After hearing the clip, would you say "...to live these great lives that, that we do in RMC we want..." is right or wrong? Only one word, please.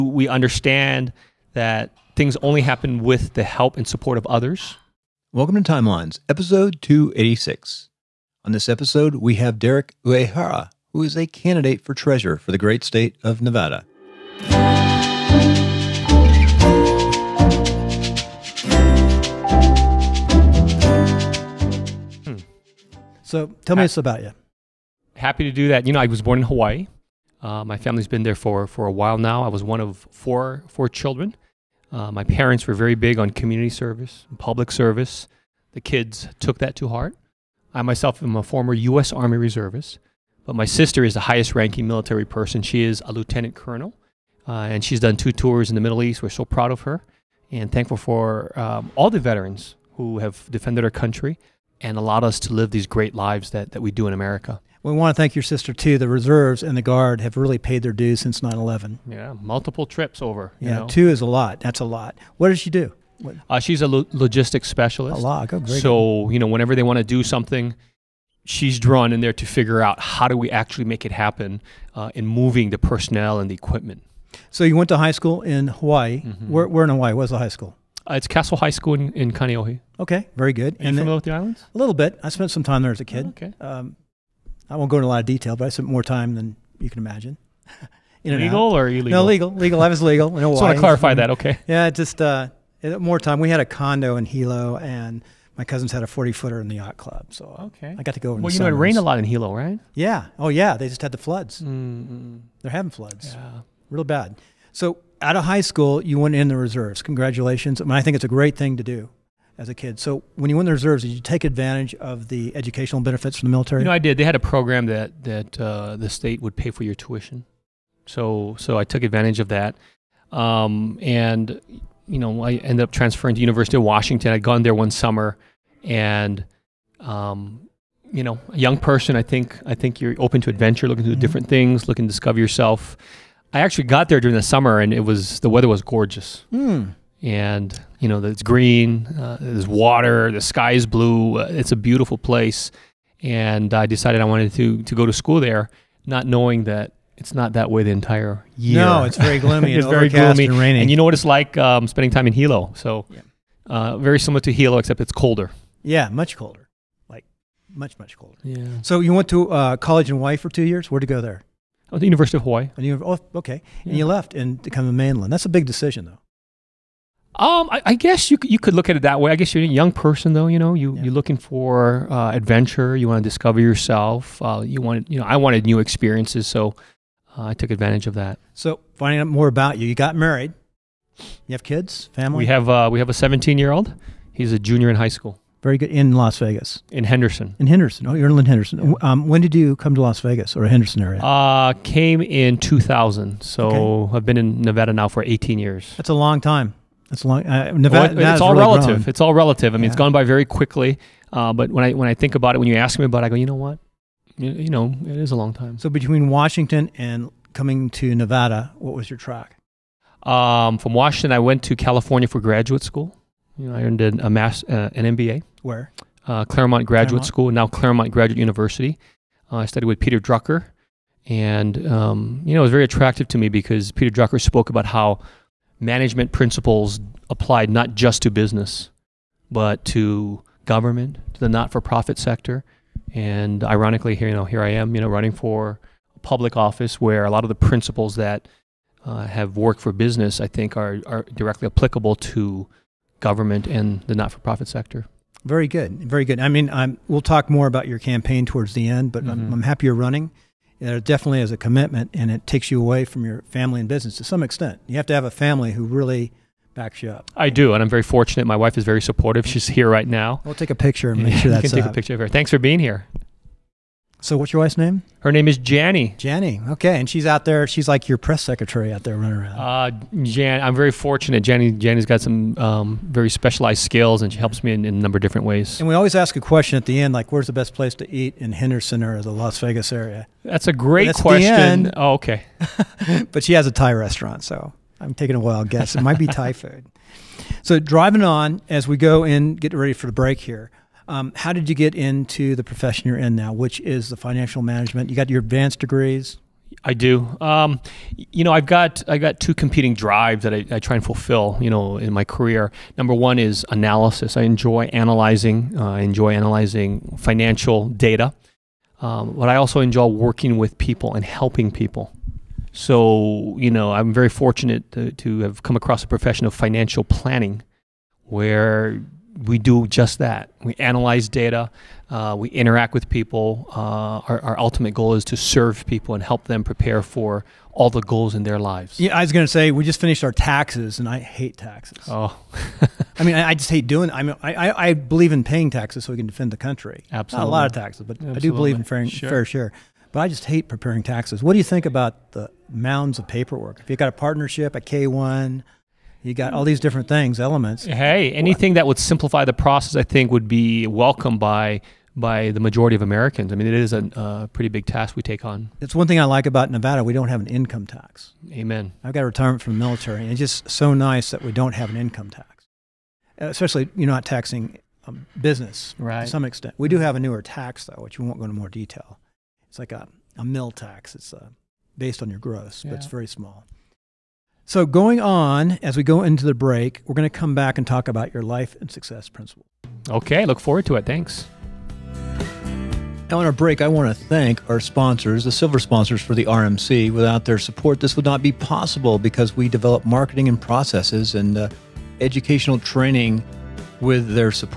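wrong.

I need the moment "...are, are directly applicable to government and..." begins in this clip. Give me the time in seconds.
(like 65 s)
240 s.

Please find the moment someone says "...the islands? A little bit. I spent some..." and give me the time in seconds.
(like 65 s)
81 s.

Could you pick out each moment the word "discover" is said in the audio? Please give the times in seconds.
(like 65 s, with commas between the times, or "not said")
132 s, 173 s.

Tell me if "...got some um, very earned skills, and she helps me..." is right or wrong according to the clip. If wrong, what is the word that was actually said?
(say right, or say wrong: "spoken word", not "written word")
wrong: "specialized", not "earned".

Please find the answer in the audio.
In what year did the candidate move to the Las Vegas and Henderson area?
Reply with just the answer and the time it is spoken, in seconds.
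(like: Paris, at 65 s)
2000, at 192 s.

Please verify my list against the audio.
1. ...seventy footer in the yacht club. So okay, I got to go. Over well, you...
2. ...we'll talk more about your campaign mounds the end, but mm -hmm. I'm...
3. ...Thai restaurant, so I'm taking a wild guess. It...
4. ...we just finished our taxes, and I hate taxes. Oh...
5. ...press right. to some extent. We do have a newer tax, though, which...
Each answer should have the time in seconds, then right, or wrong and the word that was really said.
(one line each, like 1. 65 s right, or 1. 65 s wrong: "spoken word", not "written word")
1. 96 s wrong: "forty", not "seventy"
2. 247 s wrong: "towards", not "mounds"
3. 283 s right
4. 329 s right
5. 365 s wrong: "business", not "press".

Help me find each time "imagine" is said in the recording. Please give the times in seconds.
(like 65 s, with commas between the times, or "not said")
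86 s.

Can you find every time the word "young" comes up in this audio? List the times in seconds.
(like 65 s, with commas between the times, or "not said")
128 s, 169 s.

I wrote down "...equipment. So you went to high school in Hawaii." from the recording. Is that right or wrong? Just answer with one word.
right.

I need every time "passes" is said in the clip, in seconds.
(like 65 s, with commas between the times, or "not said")
not said.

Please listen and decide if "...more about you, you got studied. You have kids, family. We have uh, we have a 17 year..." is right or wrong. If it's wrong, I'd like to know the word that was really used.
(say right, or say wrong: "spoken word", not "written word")
wrong: "married", not "studied".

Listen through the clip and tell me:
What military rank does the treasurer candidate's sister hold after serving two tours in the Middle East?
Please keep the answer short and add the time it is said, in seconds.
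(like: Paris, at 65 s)
Lieutenant colonel, at 43 s.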